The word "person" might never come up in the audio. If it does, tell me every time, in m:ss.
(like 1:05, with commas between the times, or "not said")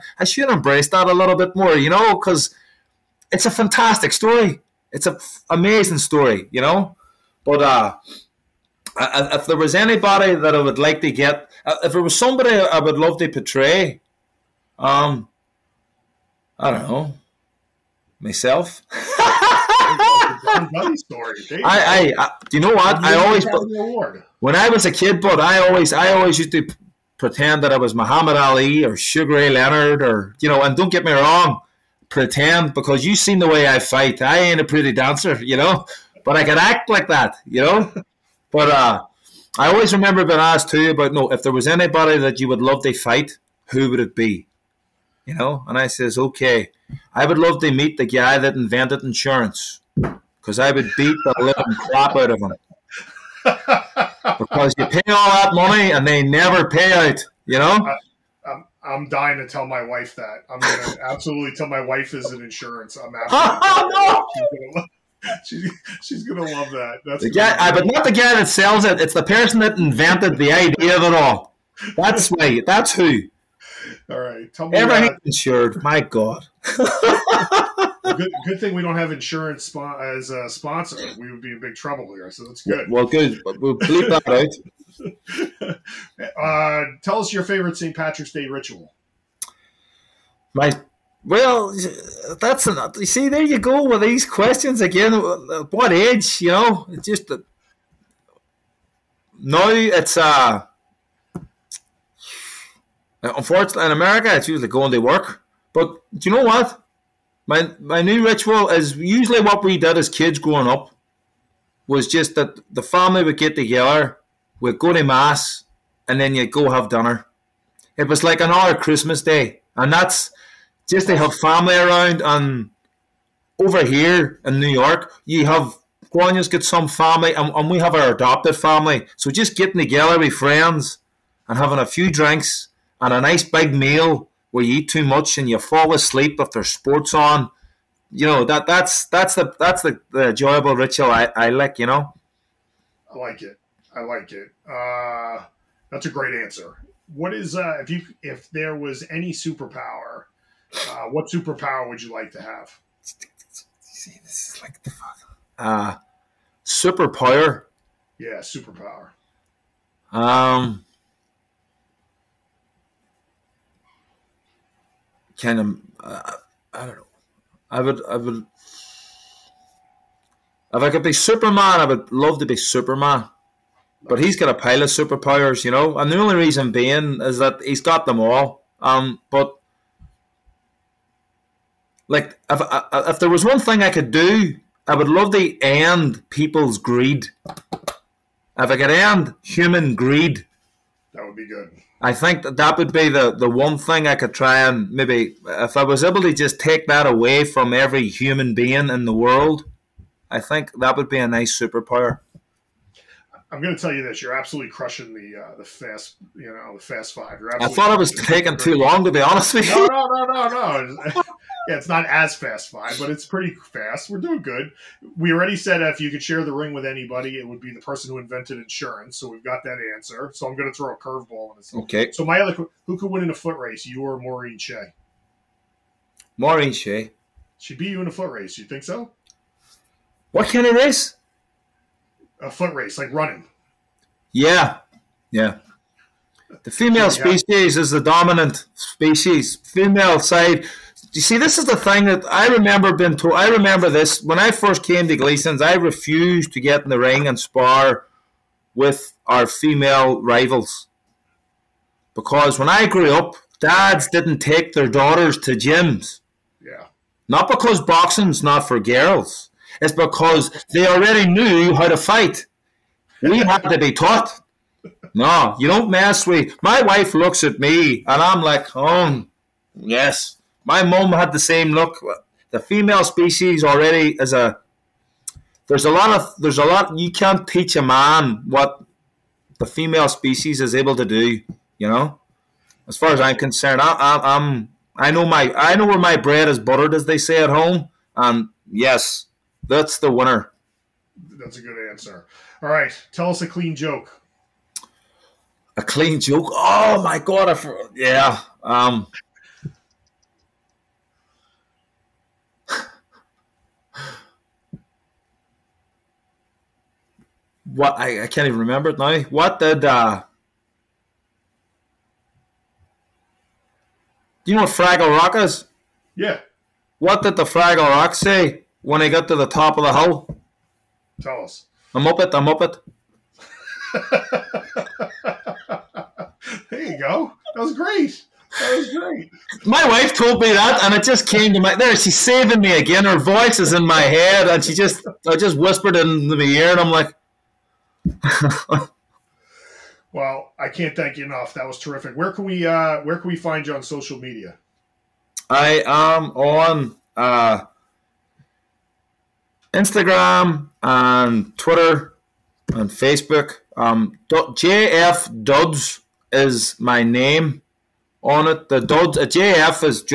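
1:09, 3:37.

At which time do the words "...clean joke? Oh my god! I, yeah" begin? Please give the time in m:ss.
4:55.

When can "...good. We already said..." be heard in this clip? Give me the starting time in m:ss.
3:34.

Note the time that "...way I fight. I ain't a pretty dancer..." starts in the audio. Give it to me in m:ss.
0:33.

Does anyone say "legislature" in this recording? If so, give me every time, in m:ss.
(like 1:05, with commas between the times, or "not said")
not said.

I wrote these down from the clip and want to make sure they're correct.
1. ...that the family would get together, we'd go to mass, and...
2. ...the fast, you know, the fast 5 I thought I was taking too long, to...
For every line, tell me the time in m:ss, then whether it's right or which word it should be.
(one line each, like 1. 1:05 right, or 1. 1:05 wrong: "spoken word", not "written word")
1. 1:52 right
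2. 3:25 right.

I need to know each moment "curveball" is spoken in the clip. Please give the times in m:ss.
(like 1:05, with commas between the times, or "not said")
3:40.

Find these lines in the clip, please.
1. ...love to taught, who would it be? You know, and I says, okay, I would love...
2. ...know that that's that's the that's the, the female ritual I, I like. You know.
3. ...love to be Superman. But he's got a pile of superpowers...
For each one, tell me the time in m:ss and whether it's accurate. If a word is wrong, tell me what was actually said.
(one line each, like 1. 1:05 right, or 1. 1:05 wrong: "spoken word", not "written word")
1. 0:42 wrong: "fight", not "taught"
2. 2:18 wrong: "enjoyable", not "female"
3. 2:52 right.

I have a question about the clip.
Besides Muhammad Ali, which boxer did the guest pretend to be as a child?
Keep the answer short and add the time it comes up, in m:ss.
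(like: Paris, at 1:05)
Sugar Ray Leonard, at 0:28.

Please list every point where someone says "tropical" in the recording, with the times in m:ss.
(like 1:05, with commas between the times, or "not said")
not said.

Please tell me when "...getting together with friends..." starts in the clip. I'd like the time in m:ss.
2:09.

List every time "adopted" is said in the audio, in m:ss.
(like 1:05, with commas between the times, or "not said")
2:08.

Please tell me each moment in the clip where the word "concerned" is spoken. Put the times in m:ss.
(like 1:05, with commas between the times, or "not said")
4:43.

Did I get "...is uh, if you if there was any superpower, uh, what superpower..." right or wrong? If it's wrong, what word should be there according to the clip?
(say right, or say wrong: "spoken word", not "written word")
right.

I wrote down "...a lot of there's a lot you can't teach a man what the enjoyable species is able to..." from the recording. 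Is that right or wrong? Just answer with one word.
wrong.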